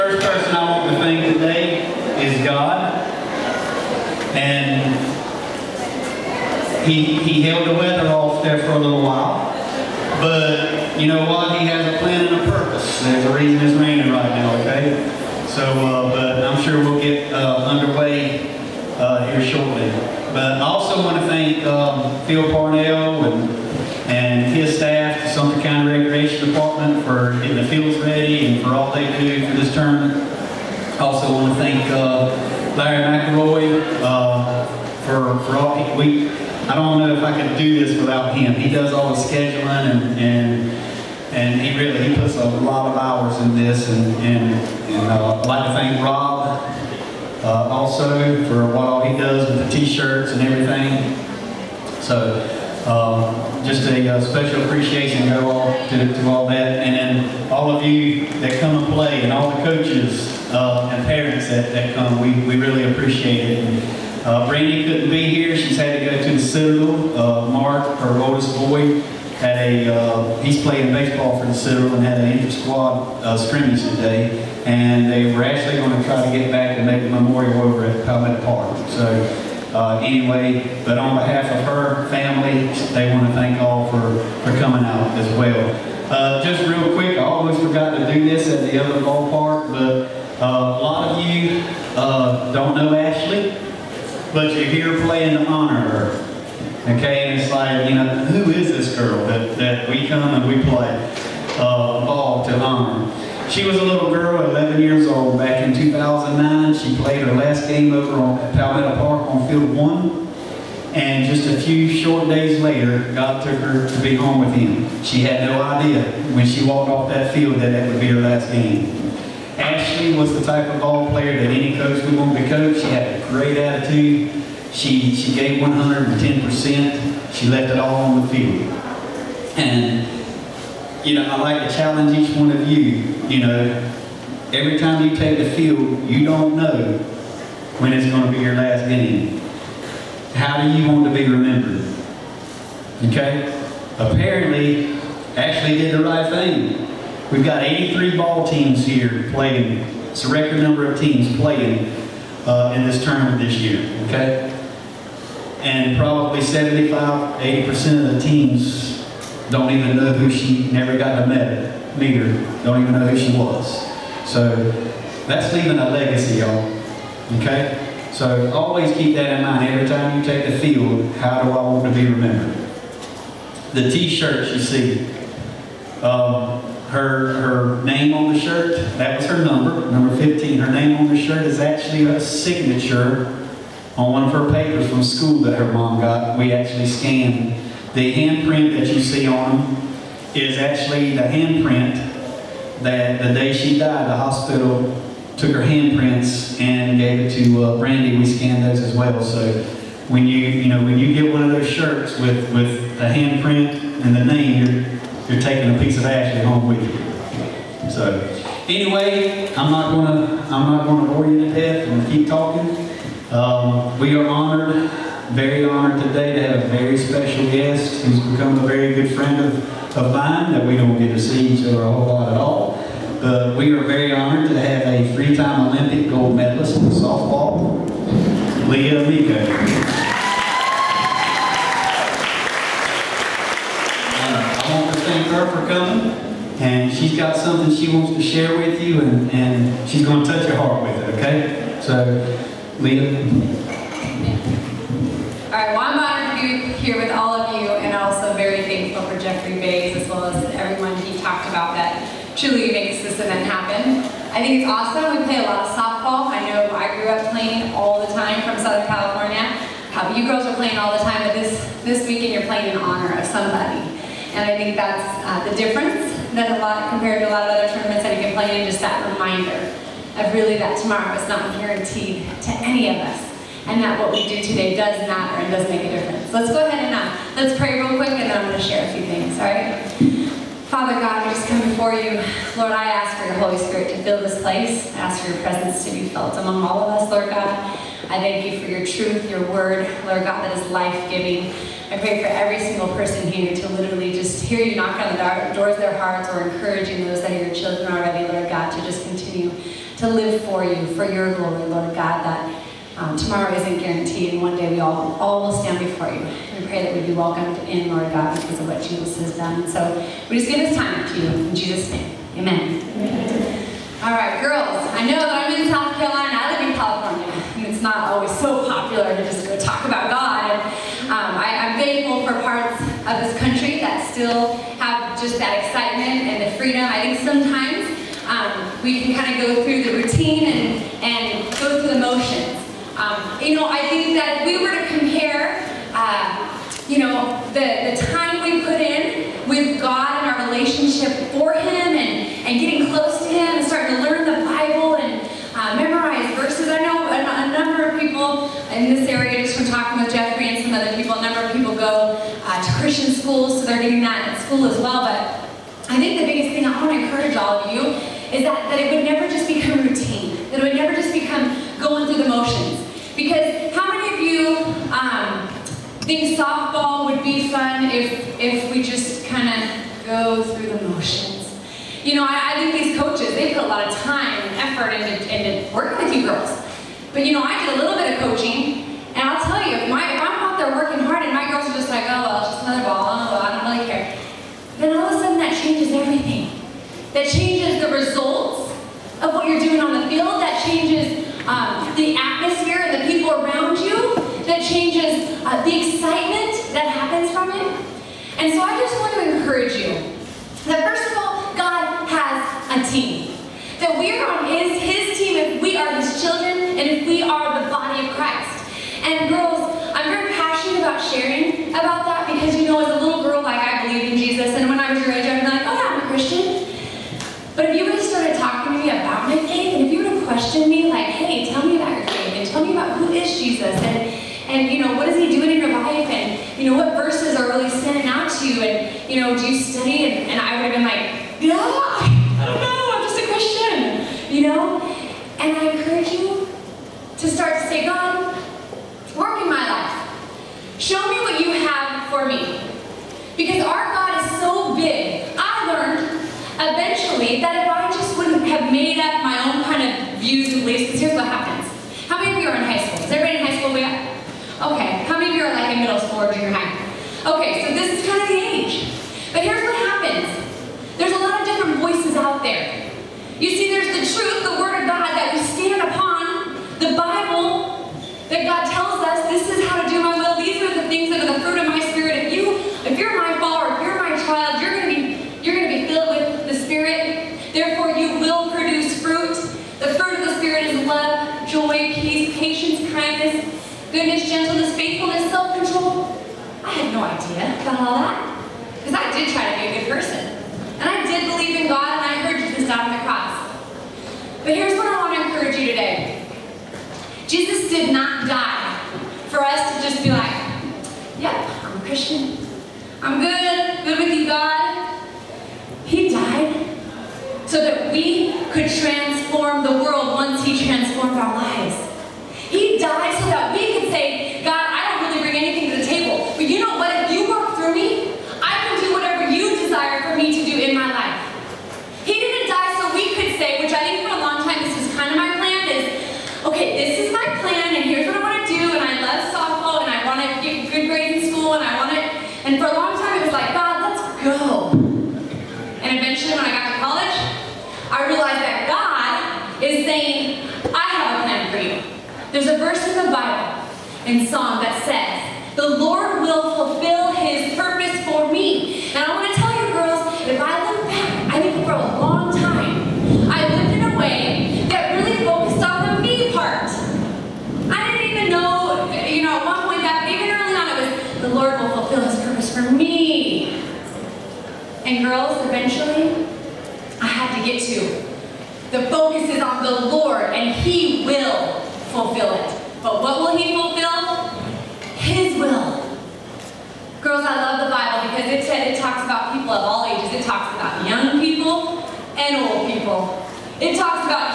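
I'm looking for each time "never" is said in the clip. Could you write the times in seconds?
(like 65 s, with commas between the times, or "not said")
160 s, 359 s.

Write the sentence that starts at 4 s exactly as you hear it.
And he, he held the weather off there for a little while.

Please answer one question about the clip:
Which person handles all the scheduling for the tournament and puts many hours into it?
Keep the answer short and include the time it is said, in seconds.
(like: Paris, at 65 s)
Larry McElroy, at 32 s.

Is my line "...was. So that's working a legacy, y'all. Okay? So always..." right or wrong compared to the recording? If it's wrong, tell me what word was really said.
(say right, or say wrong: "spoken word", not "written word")
wrong: "leaving", not "working".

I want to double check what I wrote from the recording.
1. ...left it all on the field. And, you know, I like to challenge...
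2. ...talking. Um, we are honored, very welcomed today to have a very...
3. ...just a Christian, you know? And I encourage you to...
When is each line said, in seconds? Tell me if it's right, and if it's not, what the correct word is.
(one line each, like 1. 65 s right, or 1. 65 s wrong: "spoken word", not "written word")
1. 127 s right
2. 212 s wrong: "honored", not "welcomed"
3. 433 s right.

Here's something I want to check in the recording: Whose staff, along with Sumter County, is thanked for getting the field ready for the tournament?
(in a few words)
Phil Parnell.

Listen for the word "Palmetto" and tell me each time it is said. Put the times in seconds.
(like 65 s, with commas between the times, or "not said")
78 s, 108 s.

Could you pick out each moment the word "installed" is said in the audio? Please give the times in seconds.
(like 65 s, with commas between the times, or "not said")
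not said.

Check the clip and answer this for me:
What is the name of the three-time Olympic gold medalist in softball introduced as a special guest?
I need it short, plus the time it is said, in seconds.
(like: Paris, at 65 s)
Leah Amico, at 228 s.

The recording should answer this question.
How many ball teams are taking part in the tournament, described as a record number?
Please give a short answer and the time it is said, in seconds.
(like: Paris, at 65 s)
83, at 147 s.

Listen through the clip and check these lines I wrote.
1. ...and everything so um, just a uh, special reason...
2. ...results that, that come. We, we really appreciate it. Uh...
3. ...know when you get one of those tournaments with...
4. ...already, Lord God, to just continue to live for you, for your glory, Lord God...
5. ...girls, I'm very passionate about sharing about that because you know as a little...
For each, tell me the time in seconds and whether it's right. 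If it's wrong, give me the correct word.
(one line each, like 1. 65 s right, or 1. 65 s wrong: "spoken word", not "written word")
1. 50 s wrong: "appreciation", not "reason"
2. 61 s wrong: "parents", not "results"
3. 200 s wrong: "shirts", not "tournaments"
4. 297 s right
5. 409 s right.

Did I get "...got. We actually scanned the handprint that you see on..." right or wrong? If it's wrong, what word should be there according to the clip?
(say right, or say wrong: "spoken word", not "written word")
right.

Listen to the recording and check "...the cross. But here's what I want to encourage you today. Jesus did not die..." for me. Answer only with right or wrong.
right.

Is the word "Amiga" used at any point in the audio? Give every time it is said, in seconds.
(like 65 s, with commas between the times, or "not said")
not said.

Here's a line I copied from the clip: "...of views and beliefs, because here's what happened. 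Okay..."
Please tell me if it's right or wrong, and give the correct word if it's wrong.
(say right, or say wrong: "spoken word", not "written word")
right.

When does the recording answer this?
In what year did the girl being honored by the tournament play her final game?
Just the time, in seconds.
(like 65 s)
105 s.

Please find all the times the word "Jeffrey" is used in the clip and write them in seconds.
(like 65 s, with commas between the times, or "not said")
249 s, 350 s.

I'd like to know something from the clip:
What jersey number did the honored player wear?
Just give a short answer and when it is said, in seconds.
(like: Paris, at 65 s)
15, at 179 s.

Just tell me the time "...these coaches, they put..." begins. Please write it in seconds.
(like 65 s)
372 s.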